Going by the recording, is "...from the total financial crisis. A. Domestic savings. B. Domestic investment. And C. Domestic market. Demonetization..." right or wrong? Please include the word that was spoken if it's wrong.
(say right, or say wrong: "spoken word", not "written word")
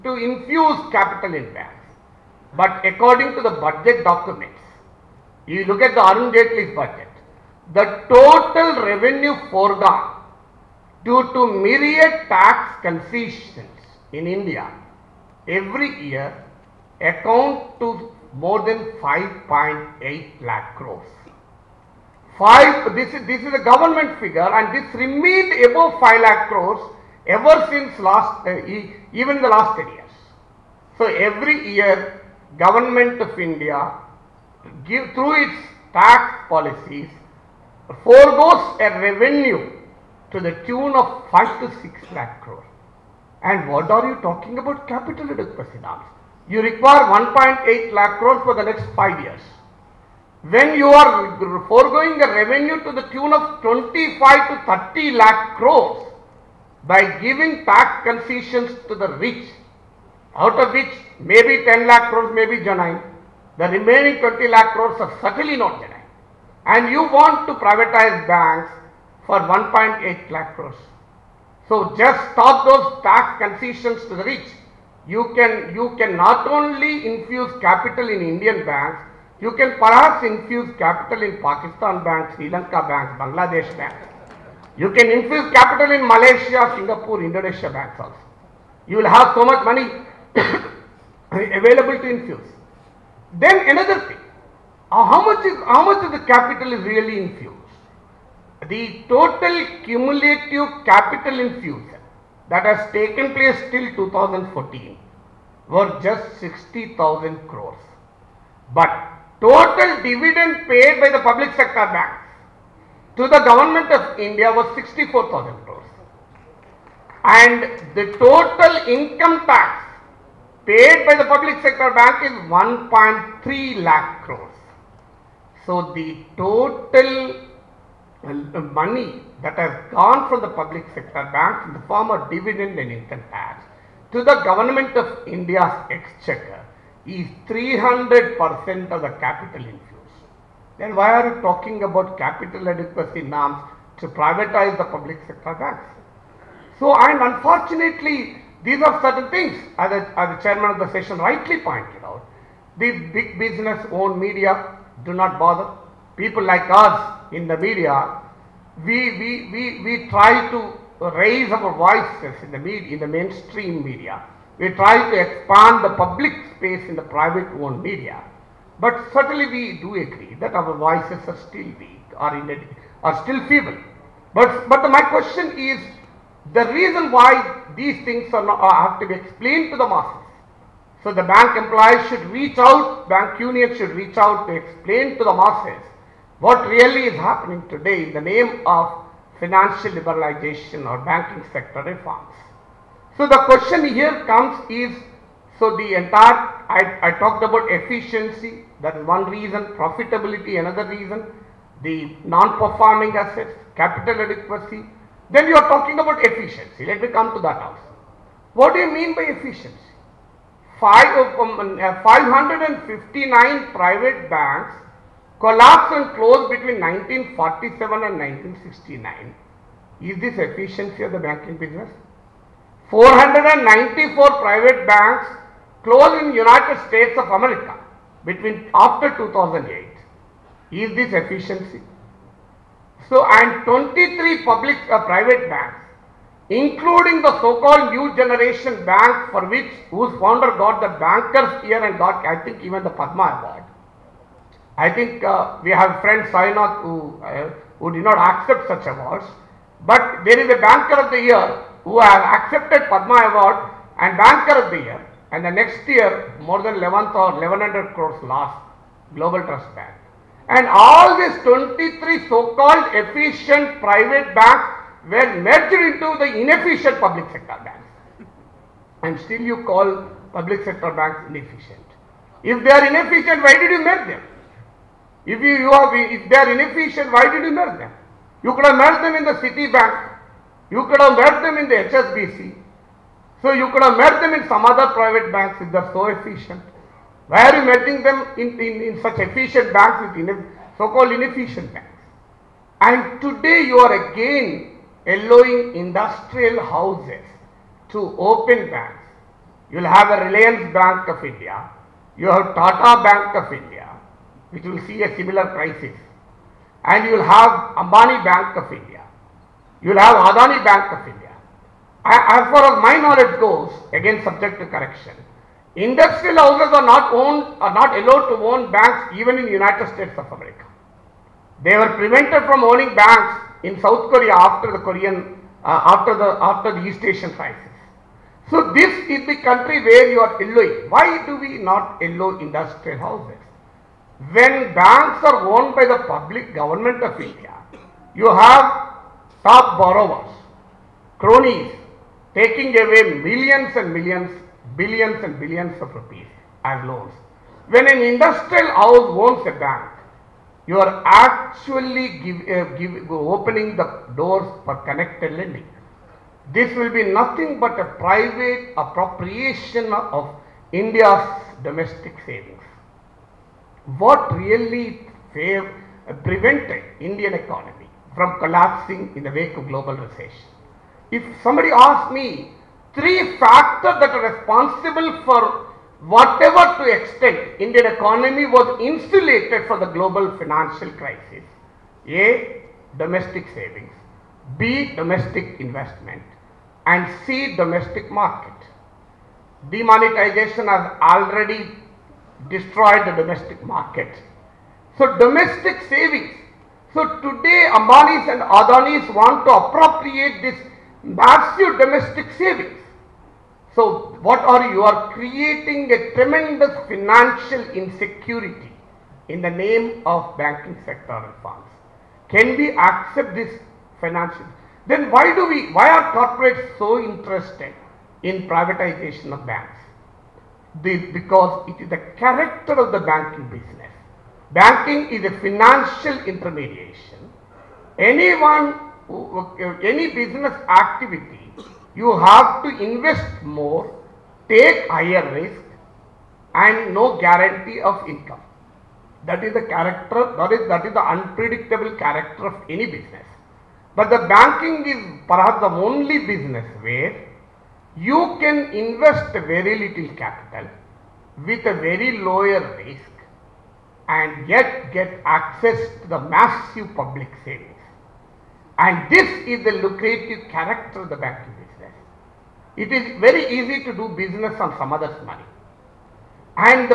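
wrong: "global", not "total".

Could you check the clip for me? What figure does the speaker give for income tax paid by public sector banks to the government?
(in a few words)
1.3 lakh crores.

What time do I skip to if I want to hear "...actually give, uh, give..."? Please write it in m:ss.
5:51.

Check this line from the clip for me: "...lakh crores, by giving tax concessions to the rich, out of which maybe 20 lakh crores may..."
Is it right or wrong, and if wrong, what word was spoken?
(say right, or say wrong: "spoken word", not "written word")
wrong: "10", not "20".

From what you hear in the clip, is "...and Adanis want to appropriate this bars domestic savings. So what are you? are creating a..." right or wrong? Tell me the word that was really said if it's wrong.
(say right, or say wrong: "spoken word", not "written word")
right.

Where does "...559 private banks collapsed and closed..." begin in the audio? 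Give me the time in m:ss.
3:32.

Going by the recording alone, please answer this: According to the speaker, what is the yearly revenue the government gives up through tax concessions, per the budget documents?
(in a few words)
5.8 lakh crores.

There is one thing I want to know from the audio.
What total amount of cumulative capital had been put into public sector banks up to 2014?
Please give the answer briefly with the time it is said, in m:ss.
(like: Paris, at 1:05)
60,000 crores, at 1:46.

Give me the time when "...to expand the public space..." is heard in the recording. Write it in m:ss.
2:45.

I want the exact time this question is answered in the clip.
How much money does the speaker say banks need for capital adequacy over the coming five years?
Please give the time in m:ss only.
0:47.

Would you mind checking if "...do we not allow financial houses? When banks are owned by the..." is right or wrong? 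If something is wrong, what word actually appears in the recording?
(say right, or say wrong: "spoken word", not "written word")
wrong: "industrial", not "financial".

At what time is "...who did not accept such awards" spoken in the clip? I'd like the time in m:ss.
4:07.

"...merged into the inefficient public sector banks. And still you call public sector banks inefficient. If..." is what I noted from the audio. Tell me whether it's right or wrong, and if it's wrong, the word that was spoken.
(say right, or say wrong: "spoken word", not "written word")
right.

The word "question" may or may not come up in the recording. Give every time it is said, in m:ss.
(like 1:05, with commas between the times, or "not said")
2:55, 3:13.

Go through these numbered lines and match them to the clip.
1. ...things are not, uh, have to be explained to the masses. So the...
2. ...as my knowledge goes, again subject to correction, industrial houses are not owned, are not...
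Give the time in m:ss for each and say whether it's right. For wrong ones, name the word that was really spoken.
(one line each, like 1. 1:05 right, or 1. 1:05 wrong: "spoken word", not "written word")
1. 2:58 right
2. 5:12 right.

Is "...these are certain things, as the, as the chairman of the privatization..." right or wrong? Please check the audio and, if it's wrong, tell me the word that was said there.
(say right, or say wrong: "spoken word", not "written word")
wrong: "session", not "privatization".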